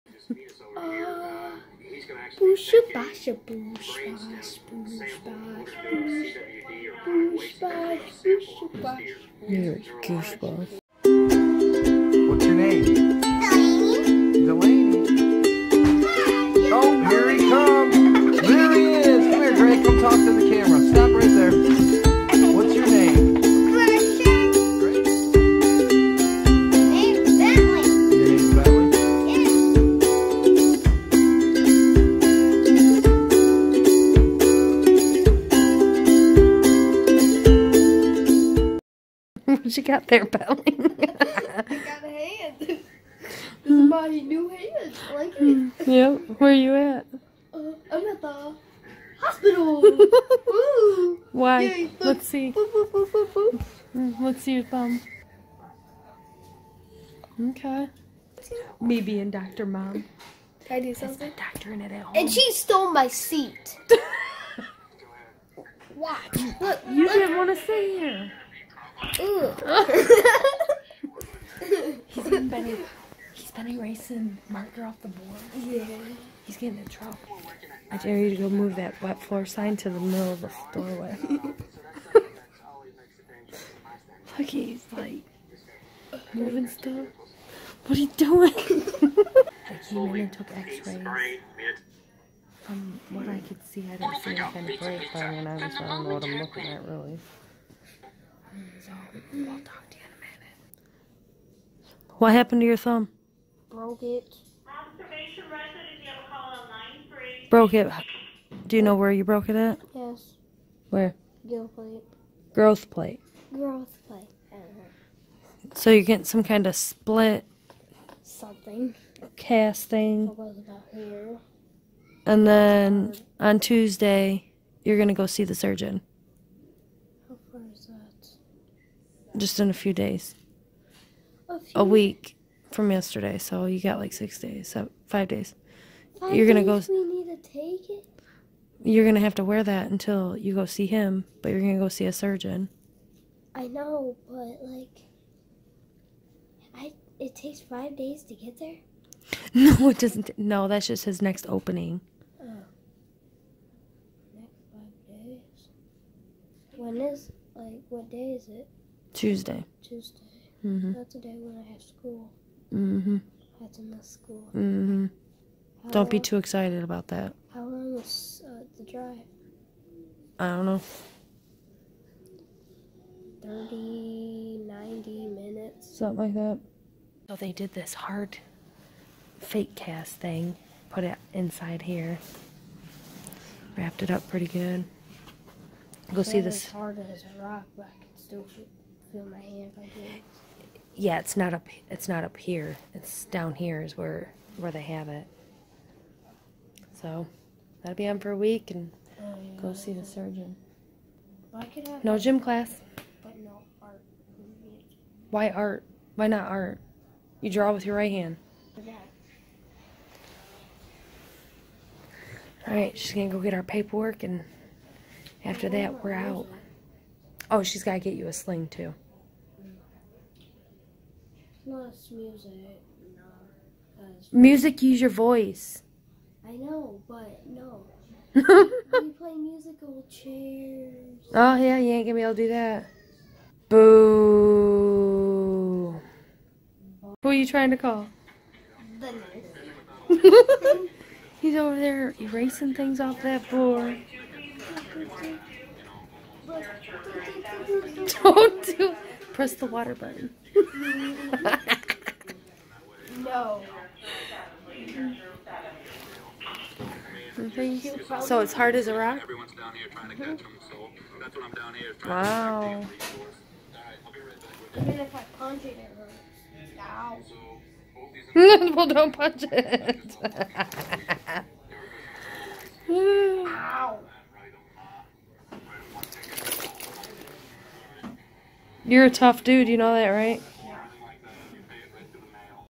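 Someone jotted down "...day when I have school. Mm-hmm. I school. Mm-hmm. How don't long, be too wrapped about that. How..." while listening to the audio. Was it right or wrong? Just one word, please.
wrong.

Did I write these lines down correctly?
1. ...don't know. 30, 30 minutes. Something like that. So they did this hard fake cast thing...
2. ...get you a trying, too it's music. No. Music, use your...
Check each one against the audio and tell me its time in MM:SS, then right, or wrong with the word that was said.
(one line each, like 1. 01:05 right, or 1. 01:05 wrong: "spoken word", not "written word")
1. 02:50 wrong: "90", not "30"
2. 03:37 wrong: "sling", not "trying".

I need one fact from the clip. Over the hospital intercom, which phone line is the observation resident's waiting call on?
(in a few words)
Line 3.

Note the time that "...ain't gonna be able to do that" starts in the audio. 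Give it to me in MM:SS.
03:51.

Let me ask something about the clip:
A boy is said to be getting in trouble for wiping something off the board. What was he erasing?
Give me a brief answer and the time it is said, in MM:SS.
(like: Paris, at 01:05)
Marker, at 01:14.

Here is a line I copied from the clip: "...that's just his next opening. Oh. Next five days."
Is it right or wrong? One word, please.
right.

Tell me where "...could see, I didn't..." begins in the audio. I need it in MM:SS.
01:33.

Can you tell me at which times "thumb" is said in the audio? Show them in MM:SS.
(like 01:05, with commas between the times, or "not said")
00:54, 01:42.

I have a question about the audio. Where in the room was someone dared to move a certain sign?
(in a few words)
Middle of the doorway.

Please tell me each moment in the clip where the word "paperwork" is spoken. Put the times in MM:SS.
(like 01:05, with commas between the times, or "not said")
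03:33.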